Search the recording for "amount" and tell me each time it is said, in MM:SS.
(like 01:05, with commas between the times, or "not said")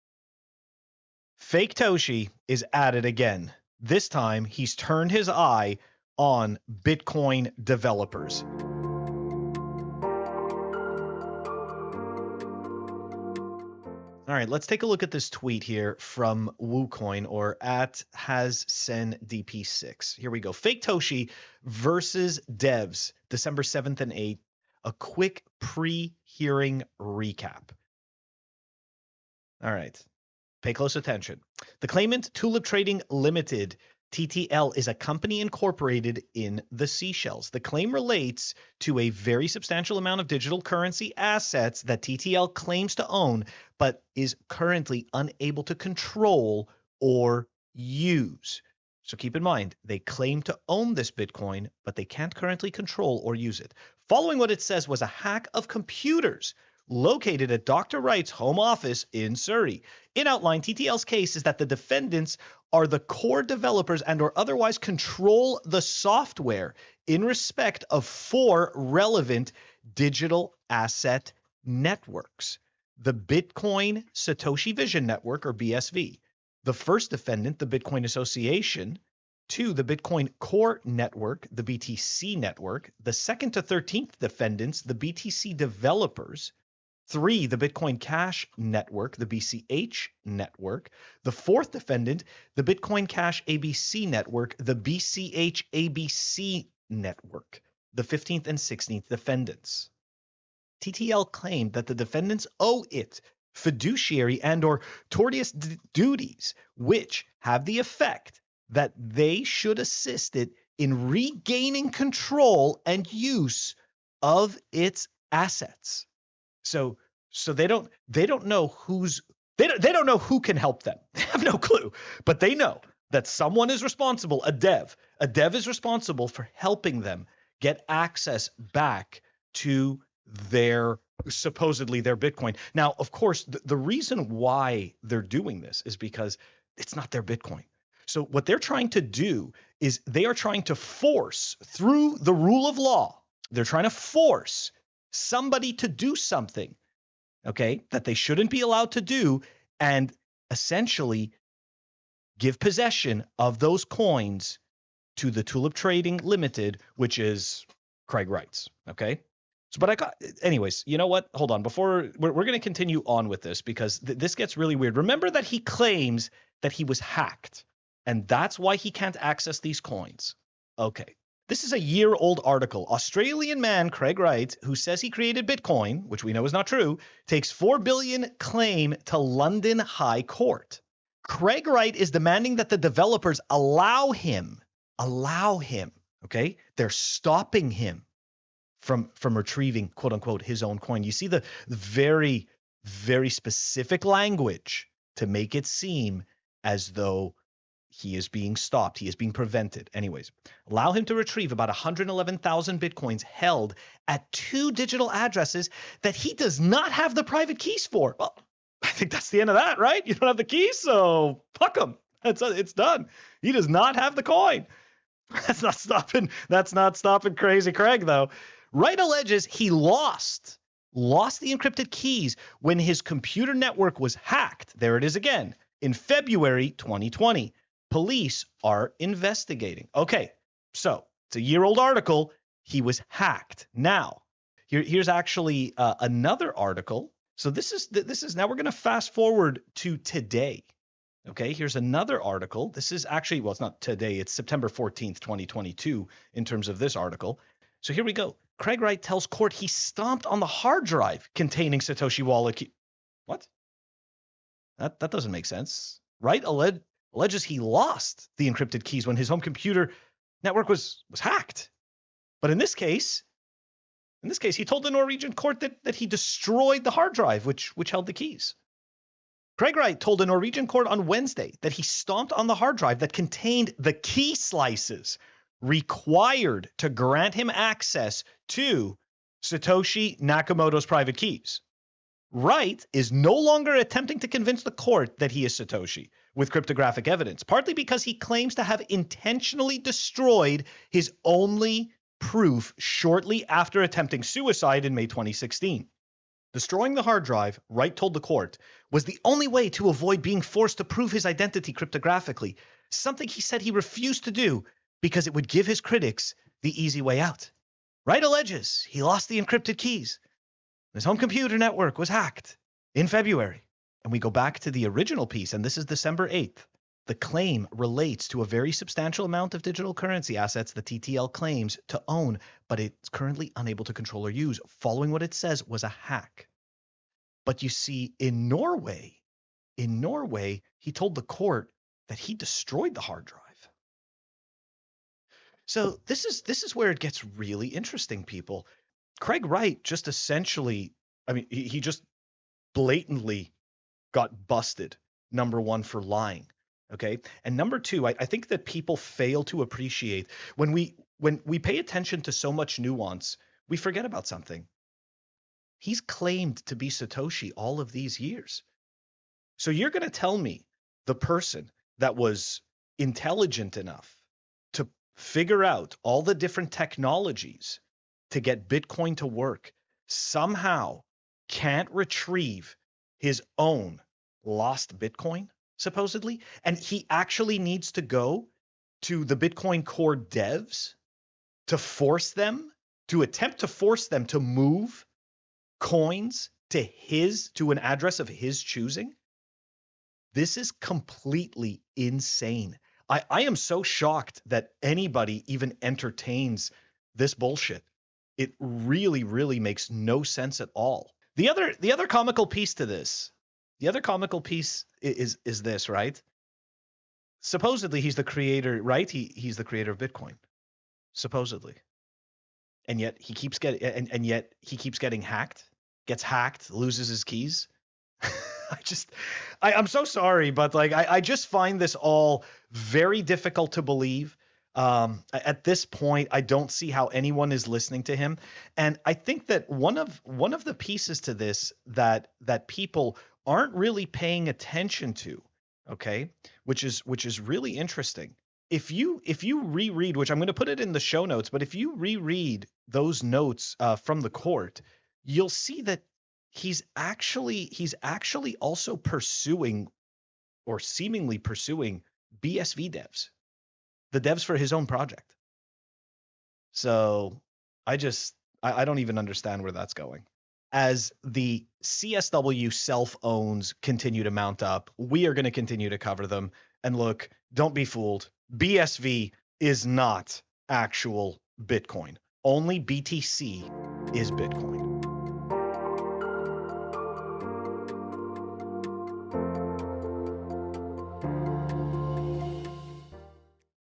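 00:39, 05:19.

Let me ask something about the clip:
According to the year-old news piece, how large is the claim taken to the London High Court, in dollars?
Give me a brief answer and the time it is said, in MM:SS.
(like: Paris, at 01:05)
4 billion, at 02:57.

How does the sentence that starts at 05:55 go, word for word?
He's claimed to be Satoshi all of these years.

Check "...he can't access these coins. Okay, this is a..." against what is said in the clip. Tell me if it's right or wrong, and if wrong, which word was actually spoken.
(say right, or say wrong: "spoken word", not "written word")
right.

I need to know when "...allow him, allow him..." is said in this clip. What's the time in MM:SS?
03:03.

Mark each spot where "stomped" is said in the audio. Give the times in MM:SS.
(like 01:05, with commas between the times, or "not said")
04:09, 04:31.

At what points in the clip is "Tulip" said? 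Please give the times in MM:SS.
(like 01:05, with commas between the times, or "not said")
00:32, 02:35.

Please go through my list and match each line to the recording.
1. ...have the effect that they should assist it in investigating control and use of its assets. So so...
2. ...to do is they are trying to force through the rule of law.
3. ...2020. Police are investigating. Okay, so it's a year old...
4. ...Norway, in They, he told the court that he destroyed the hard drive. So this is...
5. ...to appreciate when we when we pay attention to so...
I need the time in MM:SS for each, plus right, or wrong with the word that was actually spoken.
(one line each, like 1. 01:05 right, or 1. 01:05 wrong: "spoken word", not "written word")
1. 01:47 wrong: "regaining", not "investigating"
2. 02:18 right
3. 03:46 right
4. 05:28 wrong: "Norway", not "They"
5. 05:49 right.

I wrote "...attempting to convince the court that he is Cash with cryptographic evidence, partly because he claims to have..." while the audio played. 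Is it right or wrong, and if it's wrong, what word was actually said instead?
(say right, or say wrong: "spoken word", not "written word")
wrong: "Satoshi", not "Cash".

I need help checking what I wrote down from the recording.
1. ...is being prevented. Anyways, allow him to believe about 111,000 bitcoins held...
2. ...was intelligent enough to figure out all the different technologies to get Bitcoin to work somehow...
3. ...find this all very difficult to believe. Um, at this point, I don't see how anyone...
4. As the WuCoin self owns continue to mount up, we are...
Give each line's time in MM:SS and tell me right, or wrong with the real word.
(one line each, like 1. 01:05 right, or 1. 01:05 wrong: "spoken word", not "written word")
1. 03:19 wrong: "retrieve", not "believe"
2. 06:02 right
3. 07:01 right
4. 07:40 wrong: "CSW", not "WuCoin".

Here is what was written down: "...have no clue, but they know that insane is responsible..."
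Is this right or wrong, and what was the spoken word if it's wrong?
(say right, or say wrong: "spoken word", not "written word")
wrong: "someone", not "insane".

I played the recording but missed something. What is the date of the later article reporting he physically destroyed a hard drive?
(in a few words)
September 14th, 2022.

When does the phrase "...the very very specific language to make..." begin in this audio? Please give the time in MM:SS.
03:11.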